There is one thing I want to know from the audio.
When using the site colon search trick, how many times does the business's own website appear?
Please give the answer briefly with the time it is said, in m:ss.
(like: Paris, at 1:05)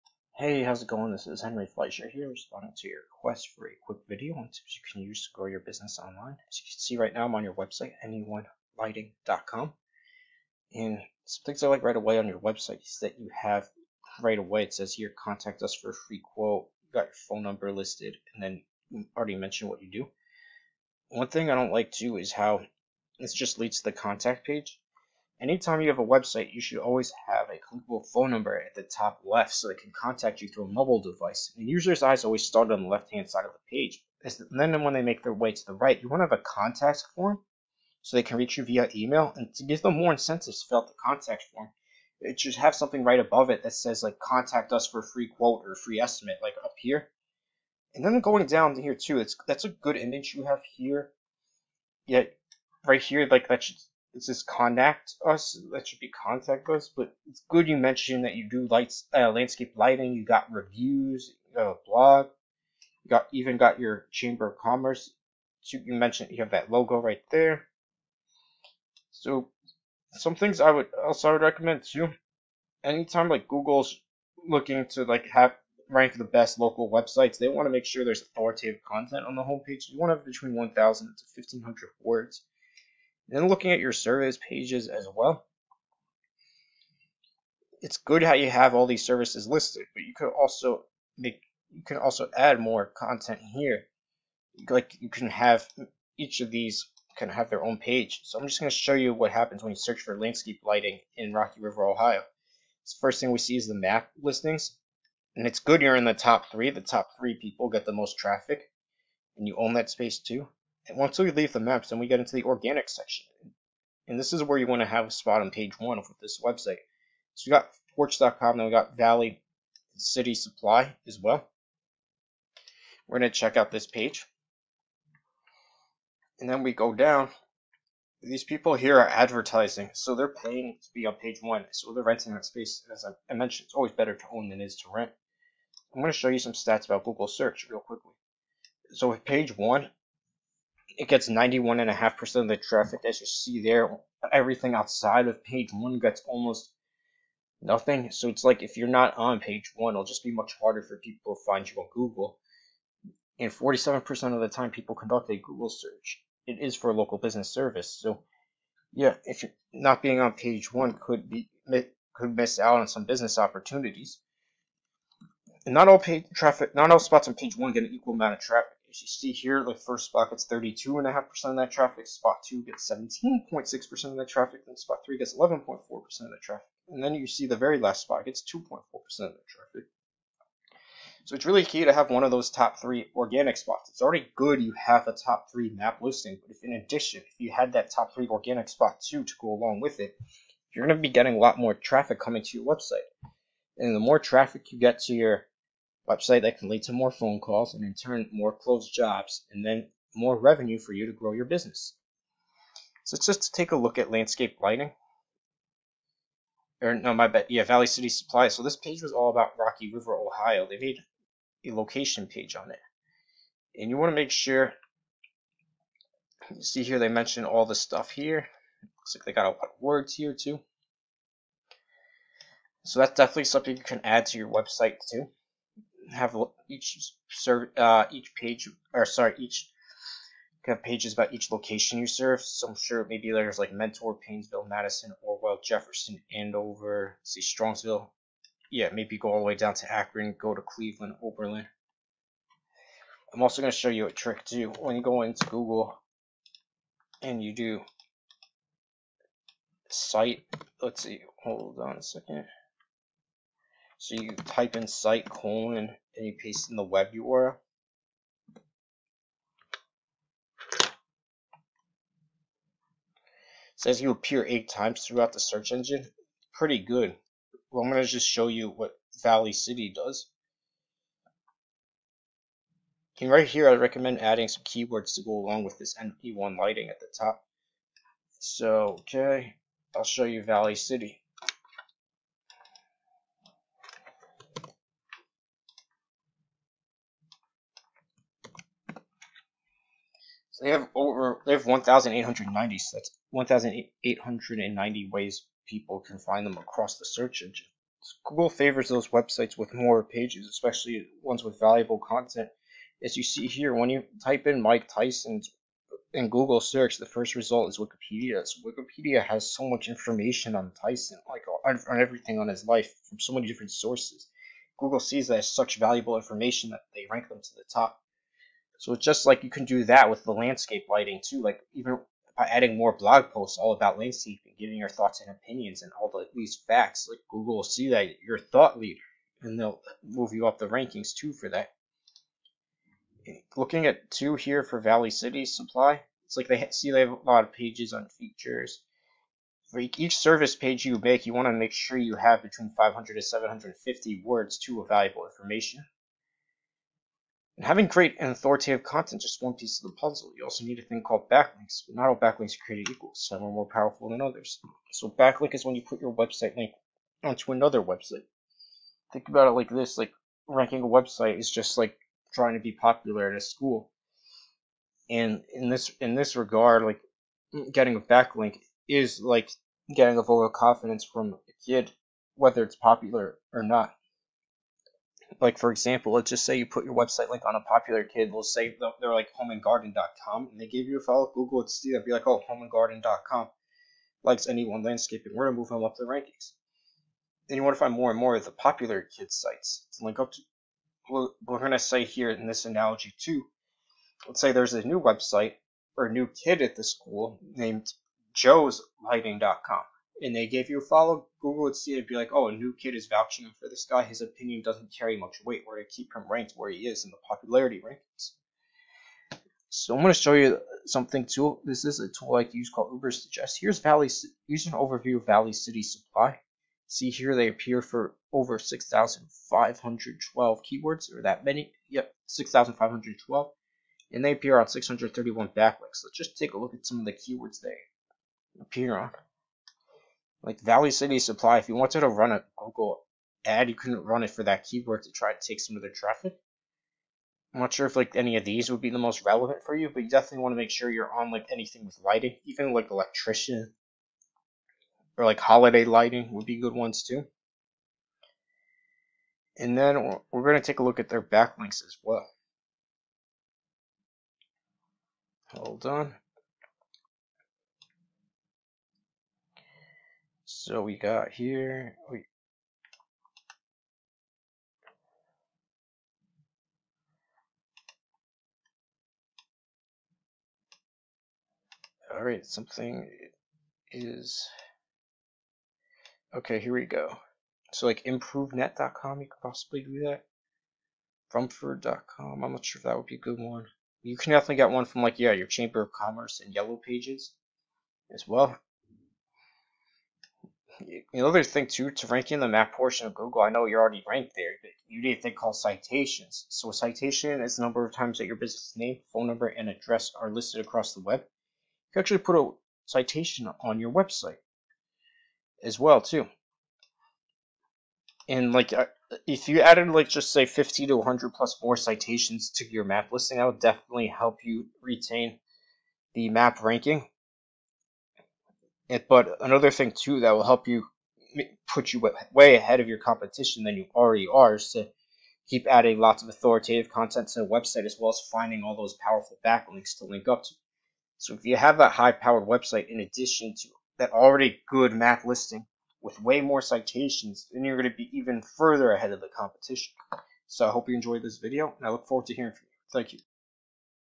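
8, at 4:24.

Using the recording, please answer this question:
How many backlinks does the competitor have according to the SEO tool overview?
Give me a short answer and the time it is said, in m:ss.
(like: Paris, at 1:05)
631, at 7:04.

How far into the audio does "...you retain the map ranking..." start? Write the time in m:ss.
8:34.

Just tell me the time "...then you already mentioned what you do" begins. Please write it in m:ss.
0:18.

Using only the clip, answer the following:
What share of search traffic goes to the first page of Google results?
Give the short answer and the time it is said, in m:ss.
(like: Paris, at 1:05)
91.5%, at 2:21.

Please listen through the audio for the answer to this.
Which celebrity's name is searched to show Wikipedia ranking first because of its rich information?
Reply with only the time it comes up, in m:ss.
5:04.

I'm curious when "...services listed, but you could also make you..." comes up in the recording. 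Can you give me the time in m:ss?
1:29.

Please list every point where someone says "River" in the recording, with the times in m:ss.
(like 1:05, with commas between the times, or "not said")
1:41, 3:29.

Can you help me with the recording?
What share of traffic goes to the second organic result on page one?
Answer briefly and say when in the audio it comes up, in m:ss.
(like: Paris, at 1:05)
17.6%, at 2:52.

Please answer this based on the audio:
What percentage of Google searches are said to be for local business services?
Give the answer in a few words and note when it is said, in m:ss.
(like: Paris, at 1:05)
47%, at 2:33.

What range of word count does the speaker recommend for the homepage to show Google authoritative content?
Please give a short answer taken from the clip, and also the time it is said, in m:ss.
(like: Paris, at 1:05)
1,000 to 1,500, at 1:20.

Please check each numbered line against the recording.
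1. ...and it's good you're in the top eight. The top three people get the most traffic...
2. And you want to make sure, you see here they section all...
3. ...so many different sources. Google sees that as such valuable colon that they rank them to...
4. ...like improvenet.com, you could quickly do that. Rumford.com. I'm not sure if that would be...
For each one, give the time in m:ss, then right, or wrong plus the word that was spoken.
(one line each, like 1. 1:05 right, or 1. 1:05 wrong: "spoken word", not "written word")
1. 1:45 wrong: "three", not "eight"
2. 3:33 wrong: "mention", not "section"
3. 5:13 wrong: "information", not "colon"
4. 7:57 wrong: "possibly", not "quickly".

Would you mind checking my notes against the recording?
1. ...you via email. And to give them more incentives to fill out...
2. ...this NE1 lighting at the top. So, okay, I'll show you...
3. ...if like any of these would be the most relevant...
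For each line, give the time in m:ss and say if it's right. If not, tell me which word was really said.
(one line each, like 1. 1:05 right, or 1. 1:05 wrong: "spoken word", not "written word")
1. 0:38 right
2. 4:35 right
3. 7:17 right.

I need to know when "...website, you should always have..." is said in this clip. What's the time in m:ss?
0:26.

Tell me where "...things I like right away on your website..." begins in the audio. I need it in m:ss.
0:11.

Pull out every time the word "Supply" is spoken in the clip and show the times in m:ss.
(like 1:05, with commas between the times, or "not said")
2:00, 3:28, 5:35, 6:55, 7:11.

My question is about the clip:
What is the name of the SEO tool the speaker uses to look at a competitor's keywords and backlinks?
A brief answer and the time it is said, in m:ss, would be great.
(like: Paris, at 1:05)
Ubersuggest, at 6:53.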